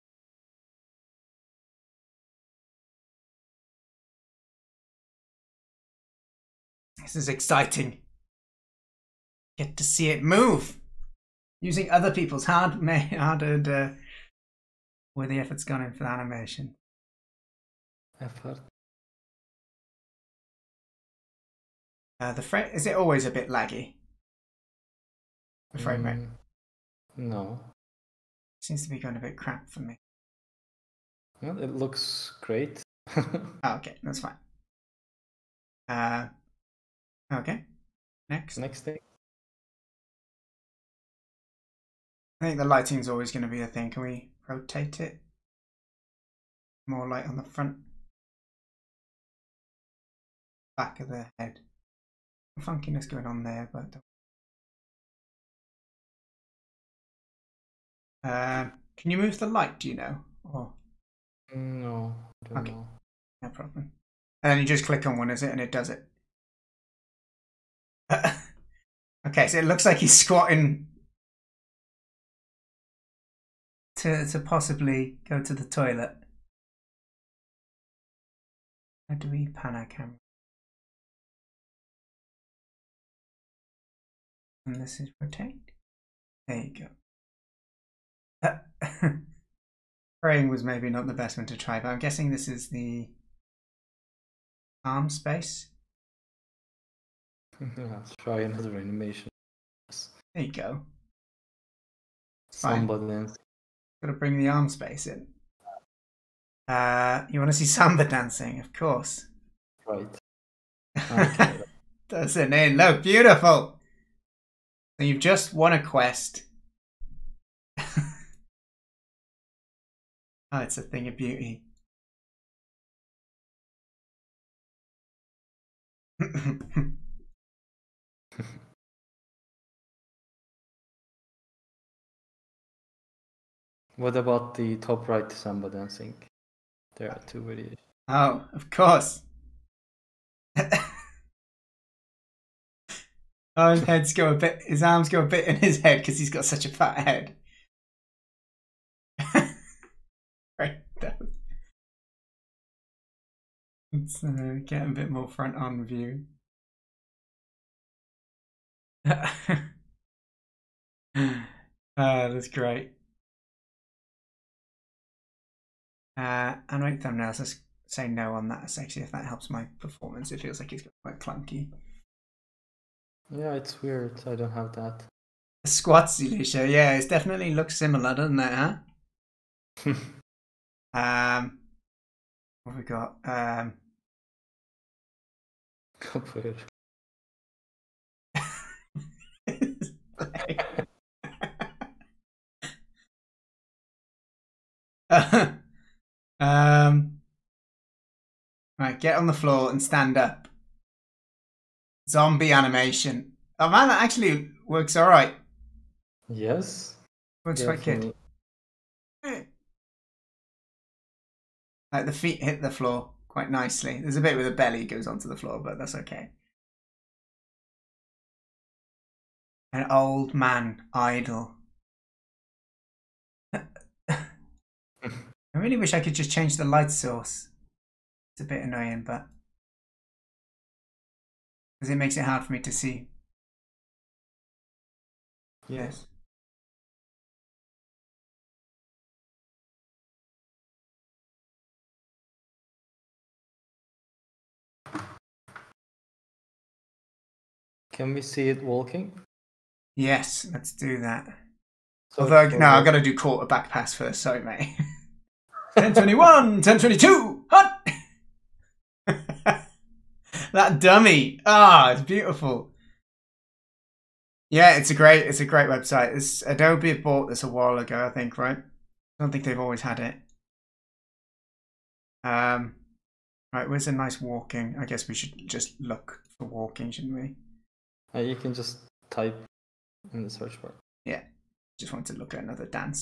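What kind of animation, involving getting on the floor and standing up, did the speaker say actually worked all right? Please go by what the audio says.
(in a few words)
Zombie animation.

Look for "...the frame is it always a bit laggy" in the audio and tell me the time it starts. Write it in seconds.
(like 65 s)
22 s.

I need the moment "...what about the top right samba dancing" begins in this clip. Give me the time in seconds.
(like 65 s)
133 s.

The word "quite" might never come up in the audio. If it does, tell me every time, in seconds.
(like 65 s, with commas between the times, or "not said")
171 s, 207 s, 213 s.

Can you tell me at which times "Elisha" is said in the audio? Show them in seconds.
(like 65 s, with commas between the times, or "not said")
176 s.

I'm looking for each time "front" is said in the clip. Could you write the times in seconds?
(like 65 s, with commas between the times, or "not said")
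47 s, 155 s.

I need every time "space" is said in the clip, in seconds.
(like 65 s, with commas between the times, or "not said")
95 s, 104 s.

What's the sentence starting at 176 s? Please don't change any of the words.
Yeah, it definitely looks similar, doesn't it, huh?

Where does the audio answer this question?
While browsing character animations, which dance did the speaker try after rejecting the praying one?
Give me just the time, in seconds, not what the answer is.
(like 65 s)
102 s.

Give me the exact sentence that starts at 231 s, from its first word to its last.
Because it makes it hard for me to see.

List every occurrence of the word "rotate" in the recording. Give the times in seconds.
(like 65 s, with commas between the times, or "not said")
44 s, 85 s.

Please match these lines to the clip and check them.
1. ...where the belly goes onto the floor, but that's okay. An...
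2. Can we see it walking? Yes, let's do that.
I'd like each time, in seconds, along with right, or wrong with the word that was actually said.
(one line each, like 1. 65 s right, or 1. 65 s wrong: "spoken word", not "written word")
1. 214 s right
2. 247 s right.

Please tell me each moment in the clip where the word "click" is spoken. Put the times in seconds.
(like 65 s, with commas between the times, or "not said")
64 s.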